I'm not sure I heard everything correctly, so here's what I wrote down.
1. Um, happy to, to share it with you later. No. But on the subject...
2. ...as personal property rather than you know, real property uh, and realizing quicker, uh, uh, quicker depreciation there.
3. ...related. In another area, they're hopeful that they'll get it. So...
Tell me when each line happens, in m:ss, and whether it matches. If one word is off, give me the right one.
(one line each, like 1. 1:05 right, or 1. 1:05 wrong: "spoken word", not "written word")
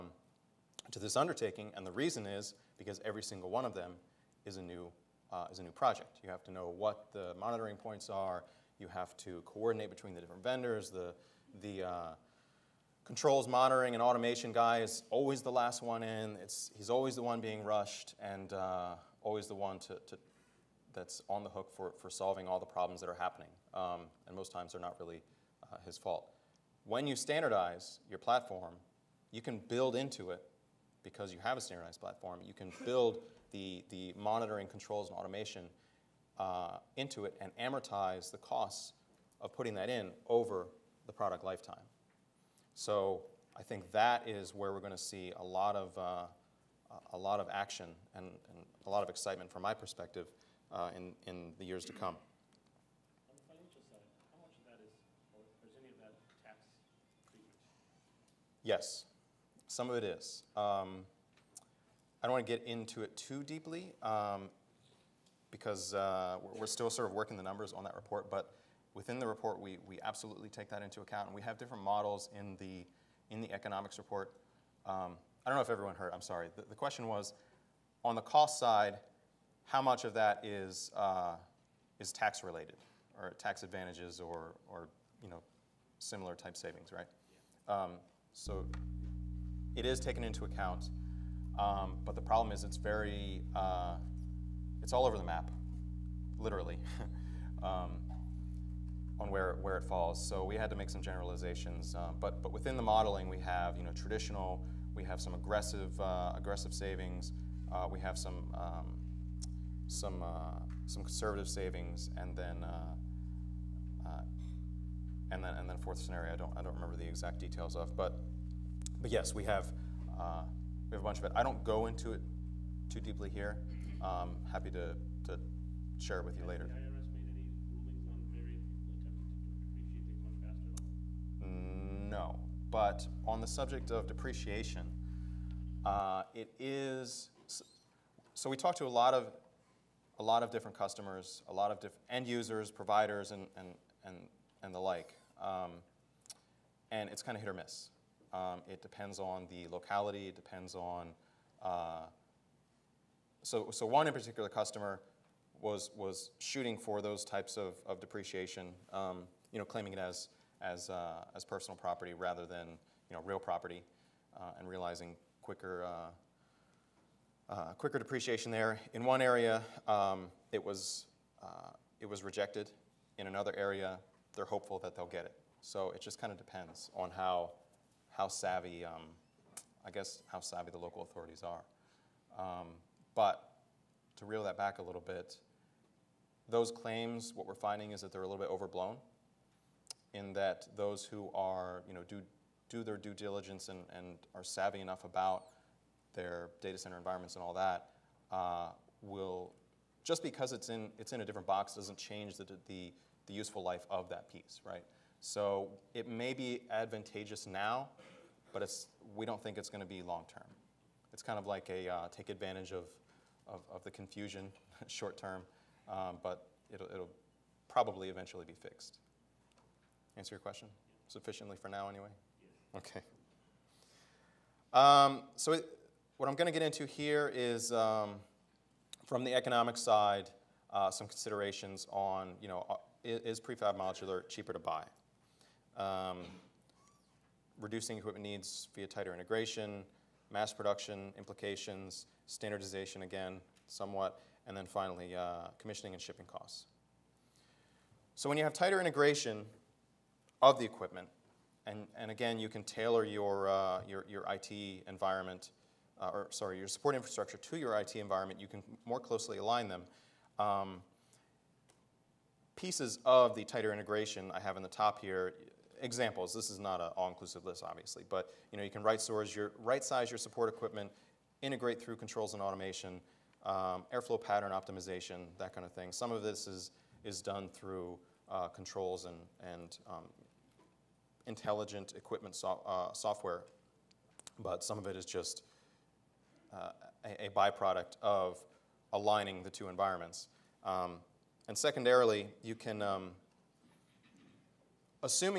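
1. 2:04 right
2. 2:41 right
3. 2:52 wrong: "rejected", not "related".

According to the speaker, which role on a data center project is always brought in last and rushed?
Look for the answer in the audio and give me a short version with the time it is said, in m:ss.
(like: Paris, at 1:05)
Controls monitoring and automation guy, at 0:13.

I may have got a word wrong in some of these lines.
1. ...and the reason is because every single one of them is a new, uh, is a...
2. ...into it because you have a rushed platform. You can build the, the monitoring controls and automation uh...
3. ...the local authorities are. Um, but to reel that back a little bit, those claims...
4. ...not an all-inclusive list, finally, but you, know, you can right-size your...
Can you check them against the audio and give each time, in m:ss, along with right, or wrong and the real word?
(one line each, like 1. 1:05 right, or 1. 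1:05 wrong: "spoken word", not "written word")
1. 0:01 right
2. 0:29 wrong: "standardized", not "rushed"
3. 3:00 right
4. 4:26 wrong: "obviously", not "finally".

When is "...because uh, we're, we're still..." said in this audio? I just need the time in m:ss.
1:05.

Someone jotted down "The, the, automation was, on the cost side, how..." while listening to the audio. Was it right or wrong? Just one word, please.
wrong.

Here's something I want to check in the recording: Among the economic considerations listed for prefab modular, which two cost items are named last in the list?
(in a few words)
Commissioning and shipping costs.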